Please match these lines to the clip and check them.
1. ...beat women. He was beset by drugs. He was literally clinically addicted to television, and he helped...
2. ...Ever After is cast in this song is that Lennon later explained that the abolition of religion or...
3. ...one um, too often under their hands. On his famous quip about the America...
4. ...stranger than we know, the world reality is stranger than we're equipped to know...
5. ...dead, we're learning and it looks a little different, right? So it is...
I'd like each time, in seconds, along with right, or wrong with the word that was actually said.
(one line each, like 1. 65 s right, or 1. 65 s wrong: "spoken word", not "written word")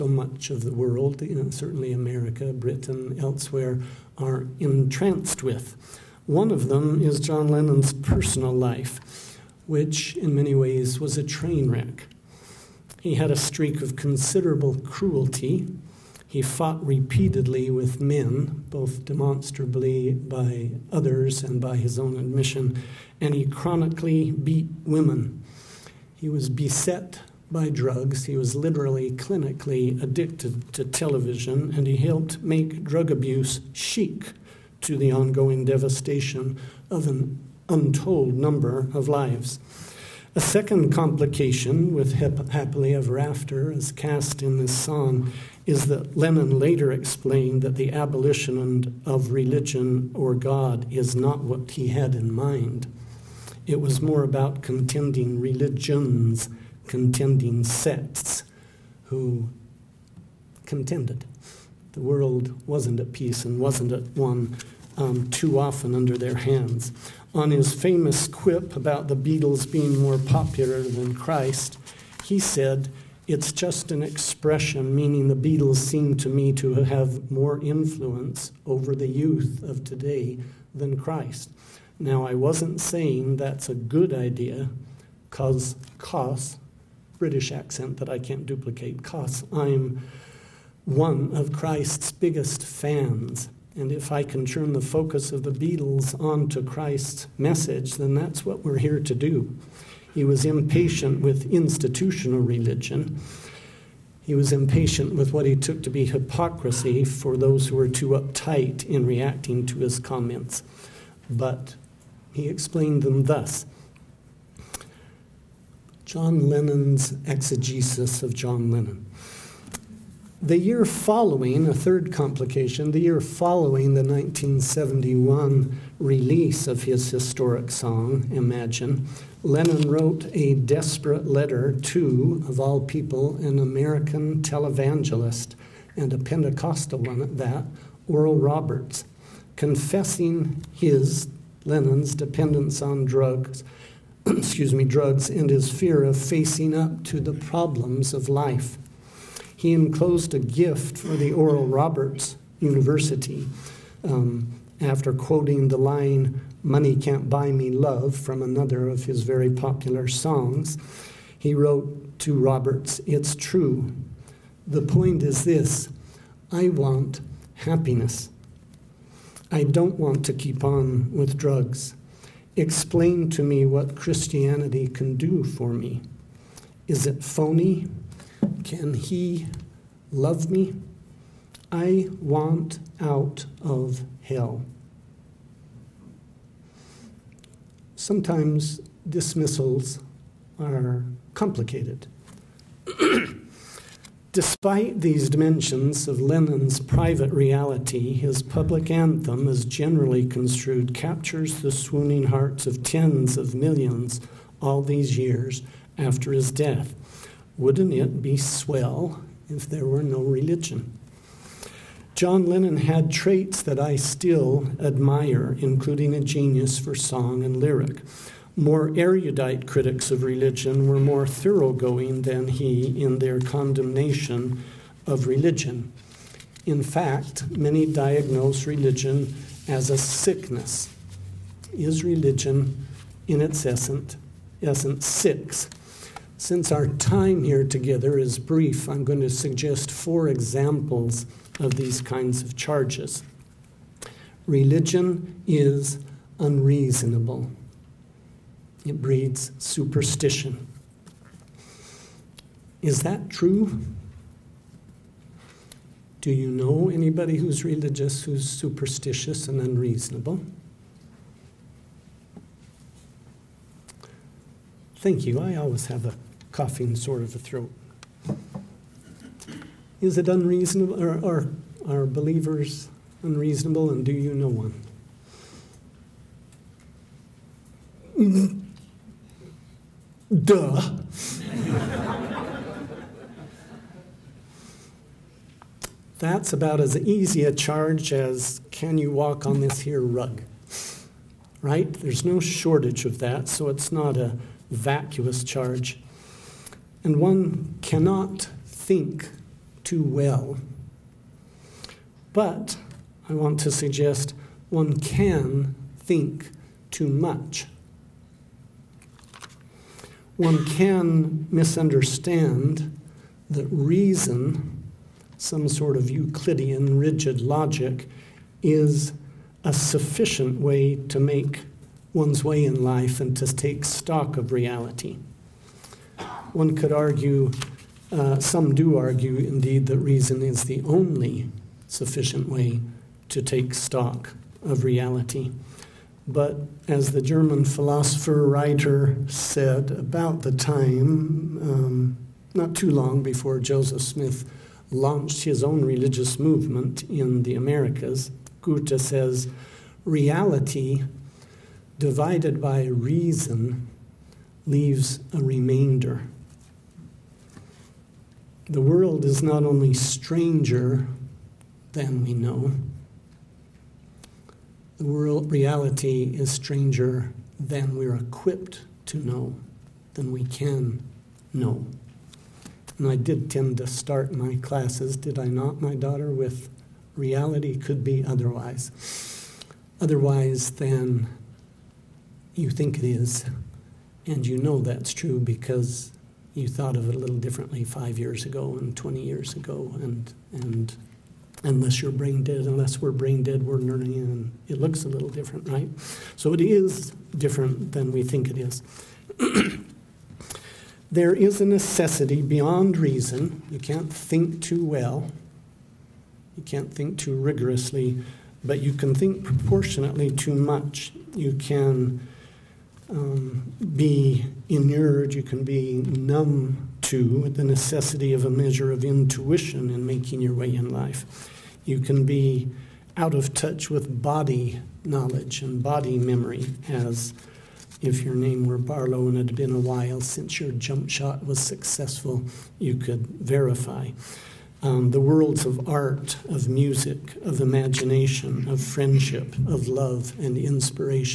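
1. 24 s right
2. 42 s right
3. 64 s wrong: "Beatles", not "America"
4. 359 s right
5. 393 s right.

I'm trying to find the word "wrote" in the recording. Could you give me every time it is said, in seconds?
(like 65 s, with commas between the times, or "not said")
129 s, 161 s.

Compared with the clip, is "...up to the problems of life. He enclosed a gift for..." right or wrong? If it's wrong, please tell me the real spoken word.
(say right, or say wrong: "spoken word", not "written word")
right.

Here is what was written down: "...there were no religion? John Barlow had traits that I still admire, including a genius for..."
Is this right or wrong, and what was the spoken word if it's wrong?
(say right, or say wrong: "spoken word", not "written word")
wrong: "Lennon", not "Barlow".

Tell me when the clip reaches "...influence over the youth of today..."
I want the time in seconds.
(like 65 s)
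77 s.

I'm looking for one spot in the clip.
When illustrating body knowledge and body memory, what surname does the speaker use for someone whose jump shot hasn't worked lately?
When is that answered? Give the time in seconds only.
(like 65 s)
428 s.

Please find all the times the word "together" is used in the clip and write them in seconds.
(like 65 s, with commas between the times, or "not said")
237 s.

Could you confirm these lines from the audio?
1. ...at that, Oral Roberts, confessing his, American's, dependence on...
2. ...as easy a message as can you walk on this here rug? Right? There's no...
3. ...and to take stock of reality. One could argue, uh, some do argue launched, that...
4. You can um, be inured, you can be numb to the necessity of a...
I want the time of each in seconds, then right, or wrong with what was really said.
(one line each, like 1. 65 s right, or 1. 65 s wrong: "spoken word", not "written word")
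1. 137 s wrong: "Lenin", not "American"
2. 286 s wrong: "charge", not "message"
3. 323 s wrong: "indeed", not "launched"
4. 411 s right.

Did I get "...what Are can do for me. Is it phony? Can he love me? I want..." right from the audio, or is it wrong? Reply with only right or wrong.
wrong.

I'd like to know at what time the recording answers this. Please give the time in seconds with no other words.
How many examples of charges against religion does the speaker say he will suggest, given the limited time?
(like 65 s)
239 s.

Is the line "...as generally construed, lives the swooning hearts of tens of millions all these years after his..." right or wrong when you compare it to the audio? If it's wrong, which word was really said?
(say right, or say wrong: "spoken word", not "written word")
wrong: "captures", not "lives".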